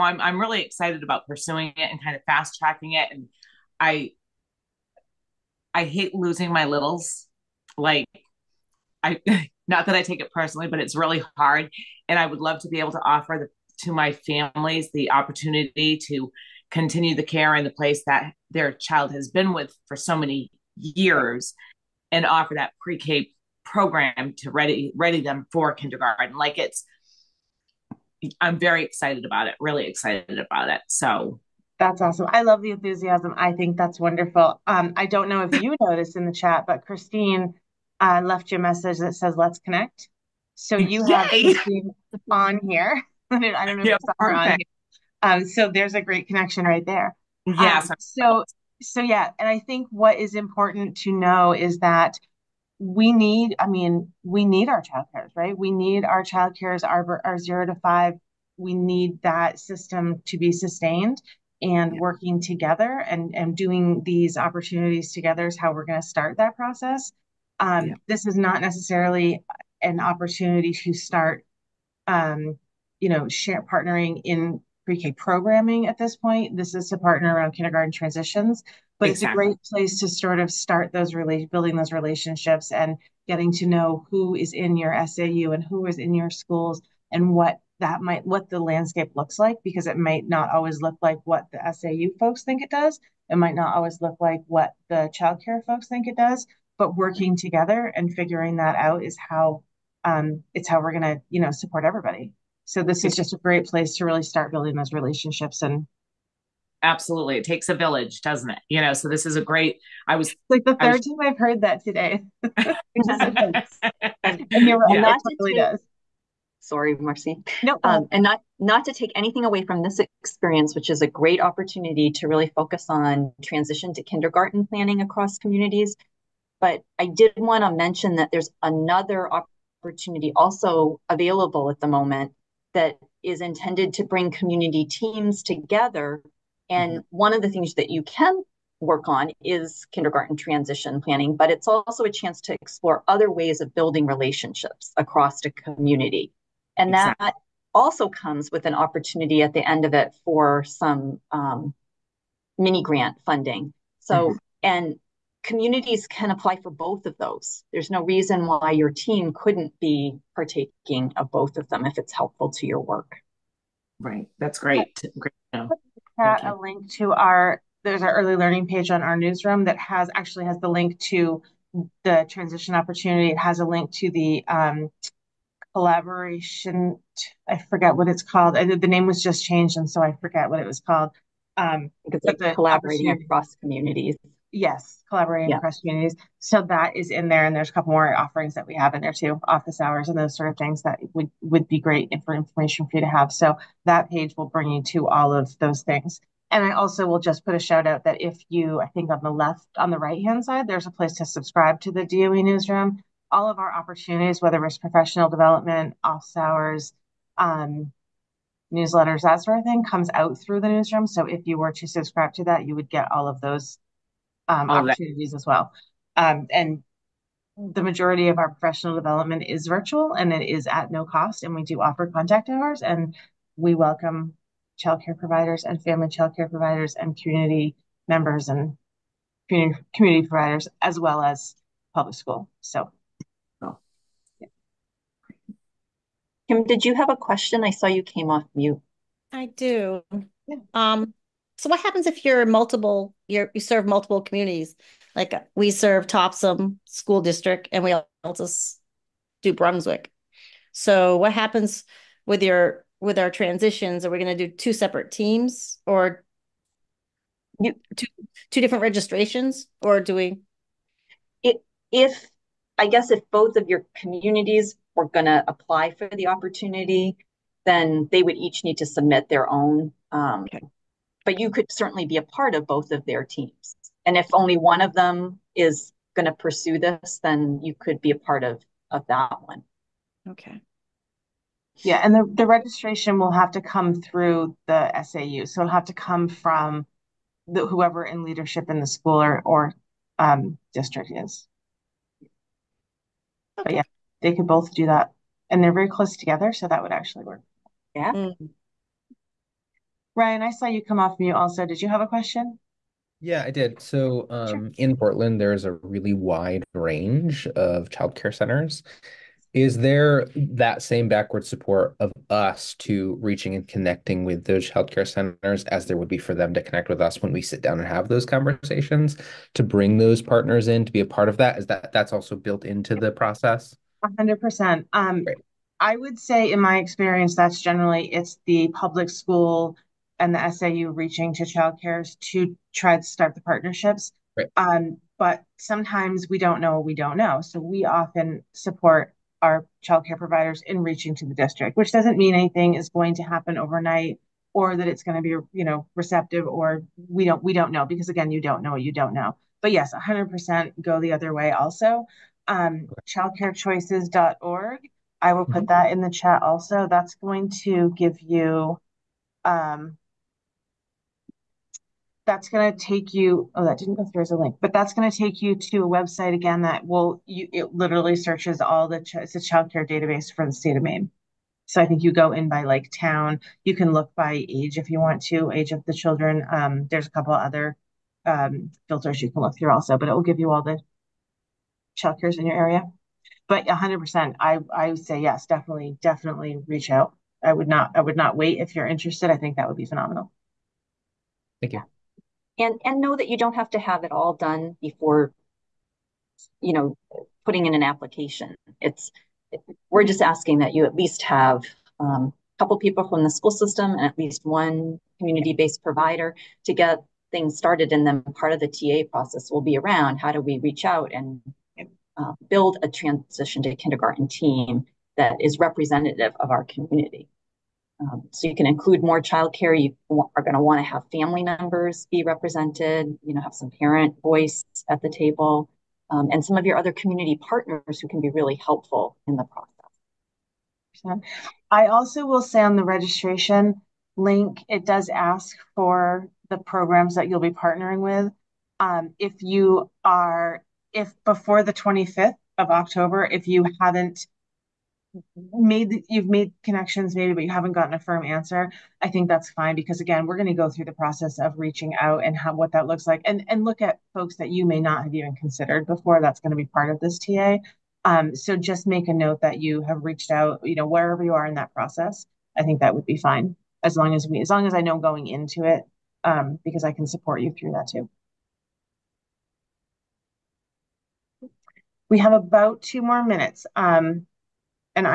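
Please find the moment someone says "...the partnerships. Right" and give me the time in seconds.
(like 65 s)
333 s.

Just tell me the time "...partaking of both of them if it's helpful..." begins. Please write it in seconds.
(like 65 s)
160 s.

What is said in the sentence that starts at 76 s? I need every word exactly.
This is to partner around kindergarten transitions but exactly.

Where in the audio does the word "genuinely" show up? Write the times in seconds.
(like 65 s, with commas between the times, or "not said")
not said.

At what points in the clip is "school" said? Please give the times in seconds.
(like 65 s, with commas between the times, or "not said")
86 s, 232 s, 246 s, 288 s, 329 s, 403 s.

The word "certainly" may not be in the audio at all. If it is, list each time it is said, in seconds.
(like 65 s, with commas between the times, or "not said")
271 s.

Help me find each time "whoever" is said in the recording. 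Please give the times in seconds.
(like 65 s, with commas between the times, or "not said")
287 s.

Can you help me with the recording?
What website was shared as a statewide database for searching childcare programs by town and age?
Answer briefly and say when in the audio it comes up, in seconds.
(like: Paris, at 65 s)
childcarechoices.org, at 353 s.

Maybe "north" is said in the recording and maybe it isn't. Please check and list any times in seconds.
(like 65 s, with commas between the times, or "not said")
not said.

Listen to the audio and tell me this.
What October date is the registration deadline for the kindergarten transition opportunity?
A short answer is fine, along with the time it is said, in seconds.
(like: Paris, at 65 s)
October 25, at 441 s.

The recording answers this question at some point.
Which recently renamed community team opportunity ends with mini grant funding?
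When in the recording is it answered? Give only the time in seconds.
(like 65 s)
182 s.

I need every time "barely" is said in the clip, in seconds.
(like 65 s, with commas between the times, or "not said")
not said.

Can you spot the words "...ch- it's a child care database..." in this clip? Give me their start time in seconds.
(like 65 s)
369 s.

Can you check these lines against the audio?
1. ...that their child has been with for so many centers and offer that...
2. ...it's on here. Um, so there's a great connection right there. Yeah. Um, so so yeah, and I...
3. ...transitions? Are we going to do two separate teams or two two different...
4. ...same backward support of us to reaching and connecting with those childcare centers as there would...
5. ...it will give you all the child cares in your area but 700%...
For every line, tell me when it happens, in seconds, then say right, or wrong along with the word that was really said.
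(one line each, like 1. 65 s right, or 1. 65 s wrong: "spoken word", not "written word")
1. 18 s wrong: "years", not "centers"
2. 43 s right
3. 253 s right
4. 310 s right
5. 380 s wrong: "100", not "700".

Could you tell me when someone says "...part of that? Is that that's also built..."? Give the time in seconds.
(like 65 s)
321 s.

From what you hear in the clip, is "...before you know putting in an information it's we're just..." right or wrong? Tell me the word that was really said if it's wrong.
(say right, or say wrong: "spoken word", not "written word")
wrong: "application", not "information".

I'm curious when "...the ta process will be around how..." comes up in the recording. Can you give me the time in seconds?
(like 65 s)
408 s.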